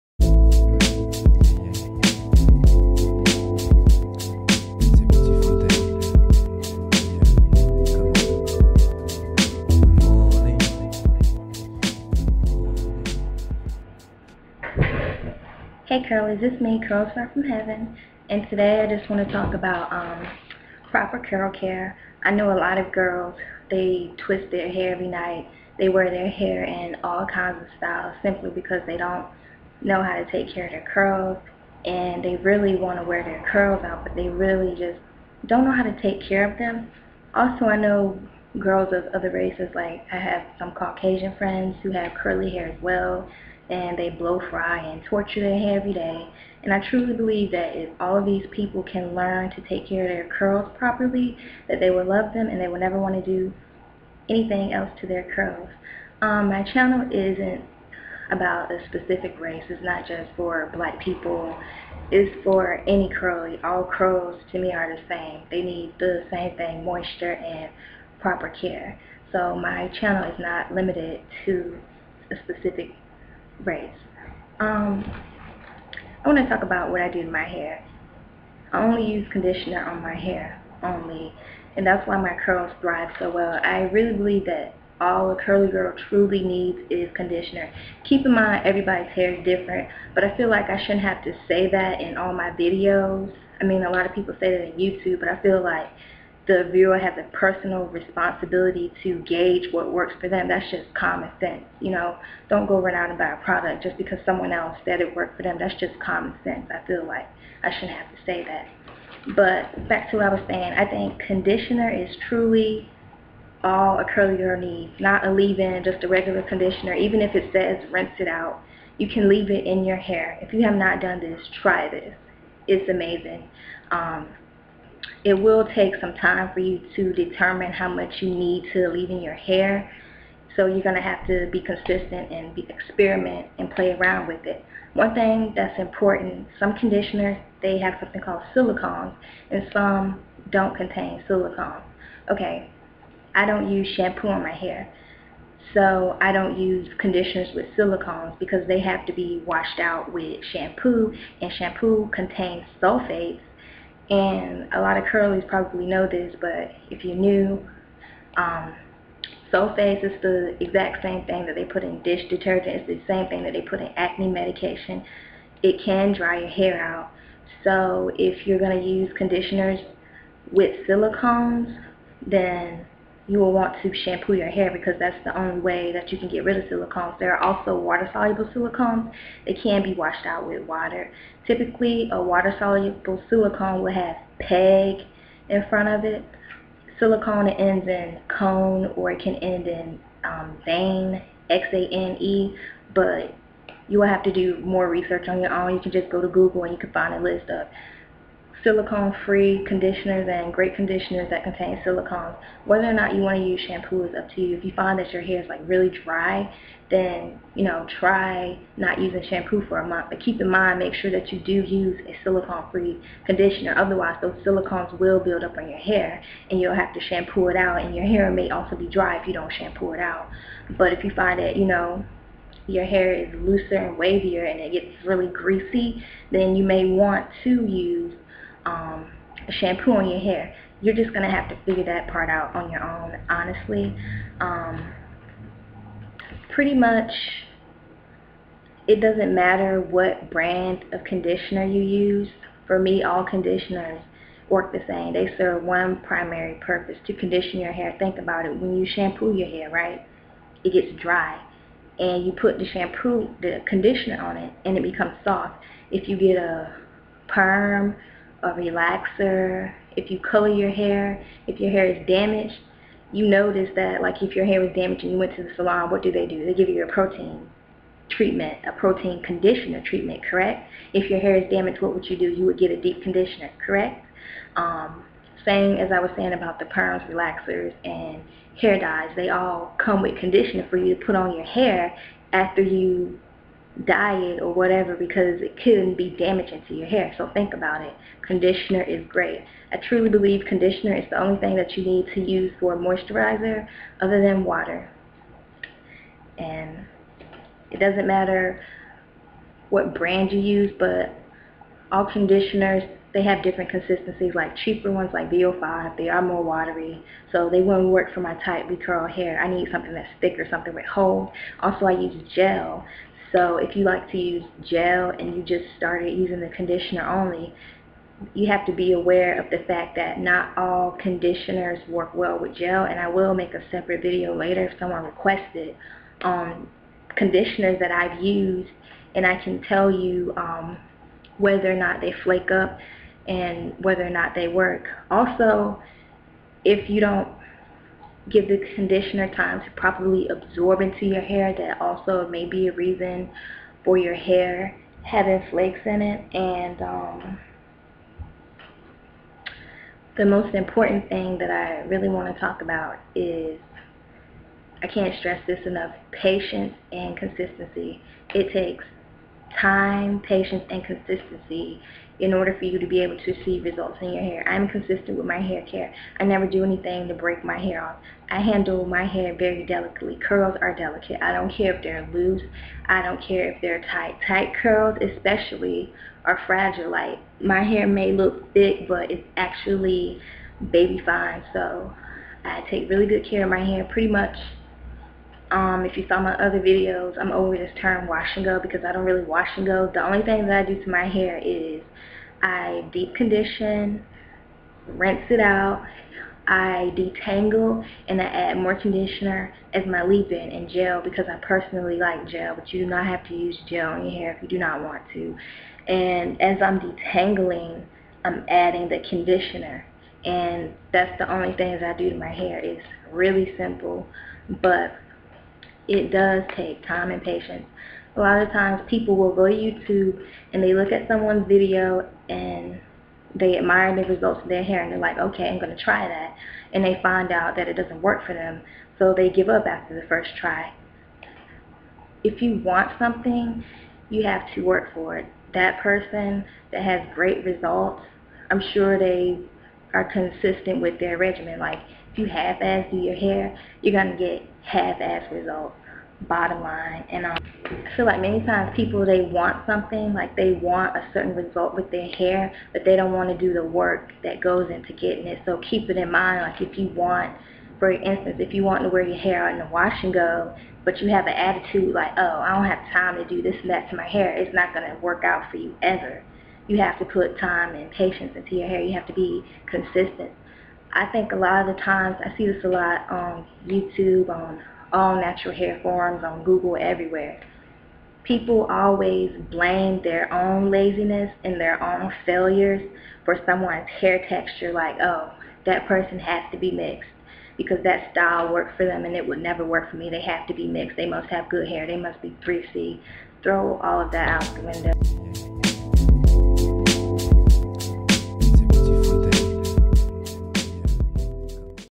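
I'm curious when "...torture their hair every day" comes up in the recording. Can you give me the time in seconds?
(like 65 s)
45 s.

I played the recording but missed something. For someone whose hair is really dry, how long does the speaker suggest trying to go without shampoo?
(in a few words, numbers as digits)
a month.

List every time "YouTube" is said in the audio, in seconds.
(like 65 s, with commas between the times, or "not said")
94 s, 419 s, 473 s.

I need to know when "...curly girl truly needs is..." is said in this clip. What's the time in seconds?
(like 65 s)
85 s.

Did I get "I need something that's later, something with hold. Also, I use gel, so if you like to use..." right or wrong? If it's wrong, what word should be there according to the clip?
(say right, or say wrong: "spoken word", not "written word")
wrong: "thicker", not "later".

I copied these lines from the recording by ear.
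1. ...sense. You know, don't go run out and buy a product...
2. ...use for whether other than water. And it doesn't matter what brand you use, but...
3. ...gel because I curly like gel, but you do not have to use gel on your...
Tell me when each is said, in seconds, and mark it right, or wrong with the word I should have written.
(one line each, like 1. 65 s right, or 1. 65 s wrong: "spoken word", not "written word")
1. 101 s right
2. 292 s wrong: "moisturizer", not "whether"
3. 400 s wrong: "personally", not "curly".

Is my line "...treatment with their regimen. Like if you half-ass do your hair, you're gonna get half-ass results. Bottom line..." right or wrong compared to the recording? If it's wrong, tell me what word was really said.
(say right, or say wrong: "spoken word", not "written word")
wrong: "consistent", not "treatment".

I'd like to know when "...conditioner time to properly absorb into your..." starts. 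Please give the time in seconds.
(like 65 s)
338 s.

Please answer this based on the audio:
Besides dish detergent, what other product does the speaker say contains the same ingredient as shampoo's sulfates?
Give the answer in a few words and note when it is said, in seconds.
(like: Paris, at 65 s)
acne medication, at 163 s.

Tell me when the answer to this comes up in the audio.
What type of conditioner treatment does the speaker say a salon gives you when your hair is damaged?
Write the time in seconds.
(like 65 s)
266 s.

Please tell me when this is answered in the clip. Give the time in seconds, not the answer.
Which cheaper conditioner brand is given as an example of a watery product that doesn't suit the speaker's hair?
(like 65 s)
305 s.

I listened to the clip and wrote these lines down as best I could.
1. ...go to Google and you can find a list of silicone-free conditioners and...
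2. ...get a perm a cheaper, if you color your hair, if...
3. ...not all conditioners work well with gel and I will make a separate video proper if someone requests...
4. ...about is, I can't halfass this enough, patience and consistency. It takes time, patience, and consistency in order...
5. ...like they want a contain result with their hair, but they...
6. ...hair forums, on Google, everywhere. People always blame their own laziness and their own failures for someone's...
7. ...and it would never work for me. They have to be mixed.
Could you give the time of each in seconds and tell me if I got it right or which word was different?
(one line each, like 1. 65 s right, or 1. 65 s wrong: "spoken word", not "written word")
1. 196 s right
2. 256 s wrong: "relaxer", not "cheaper"
3. 320 s wrong: "later", not "proper"
4. 352 s wrong: "stress", not "halfass"
5. 450 s wrong: "certain", not "contain"
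6. 475 s right
7. 489 s right.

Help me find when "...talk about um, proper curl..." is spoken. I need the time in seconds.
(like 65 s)
19 s.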